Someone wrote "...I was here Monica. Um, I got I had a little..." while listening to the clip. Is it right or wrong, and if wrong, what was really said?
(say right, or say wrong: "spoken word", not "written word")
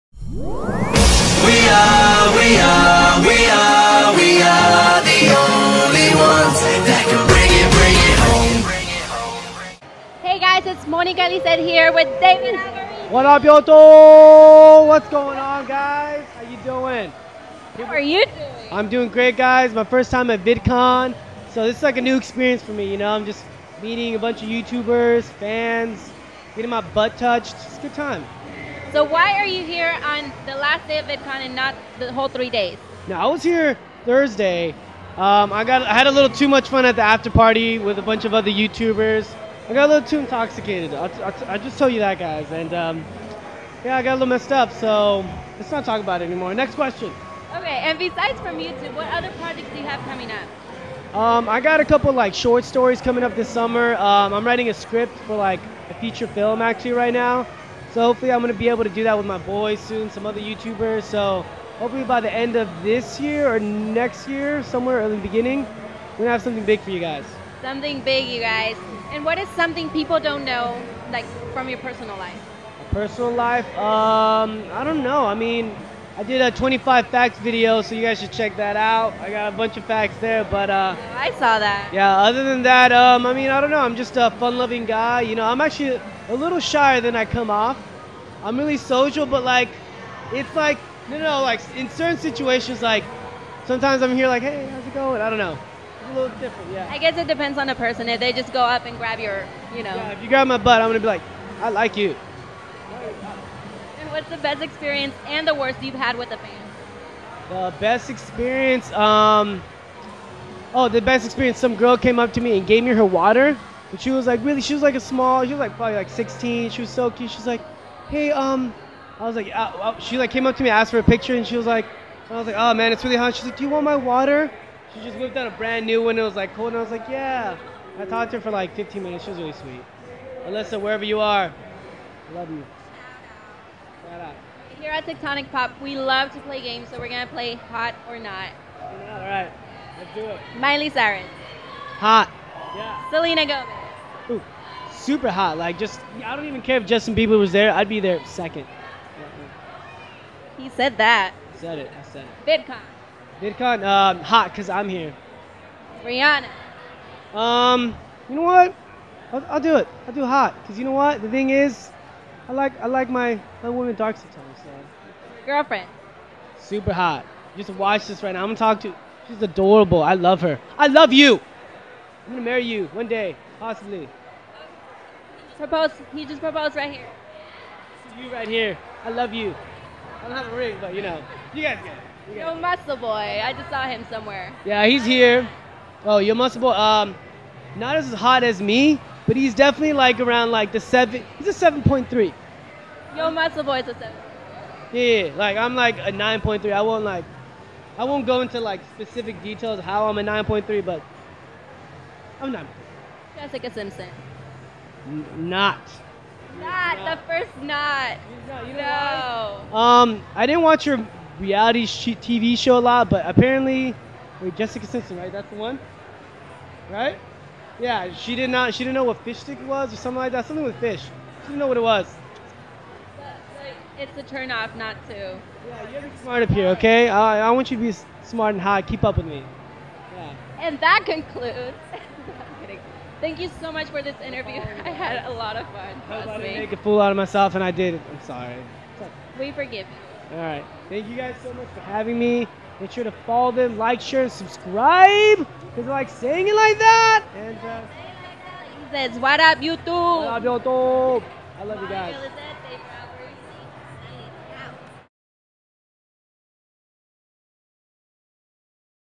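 wrong: "Thursday", not "Monica".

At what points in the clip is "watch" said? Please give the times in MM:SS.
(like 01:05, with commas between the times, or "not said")
02:47, 03:30.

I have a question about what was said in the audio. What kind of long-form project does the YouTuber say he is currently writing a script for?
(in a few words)
feature film.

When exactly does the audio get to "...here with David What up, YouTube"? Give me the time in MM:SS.
00:11.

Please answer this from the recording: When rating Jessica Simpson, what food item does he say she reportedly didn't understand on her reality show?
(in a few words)
fish stick.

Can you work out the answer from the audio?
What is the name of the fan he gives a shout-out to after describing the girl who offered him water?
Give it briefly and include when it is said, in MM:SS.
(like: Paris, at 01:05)
Alyssa, at 02:10.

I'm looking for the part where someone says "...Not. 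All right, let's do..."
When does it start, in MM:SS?
02:18.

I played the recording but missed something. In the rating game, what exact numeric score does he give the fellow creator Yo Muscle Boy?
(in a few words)
7.3.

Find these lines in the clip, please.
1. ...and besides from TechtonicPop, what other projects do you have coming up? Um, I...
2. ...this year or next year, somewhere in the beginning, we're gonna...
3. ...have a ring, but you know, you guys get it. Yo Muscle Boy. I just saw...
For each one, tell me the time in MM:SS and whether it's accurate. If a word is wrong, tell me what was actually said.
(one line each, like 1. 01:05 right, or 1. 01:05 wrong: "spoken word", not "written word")
1. 00:47 wrong: "YouTube", not "TechtonicPop"
2. 01:02 right
3. 03:00 right.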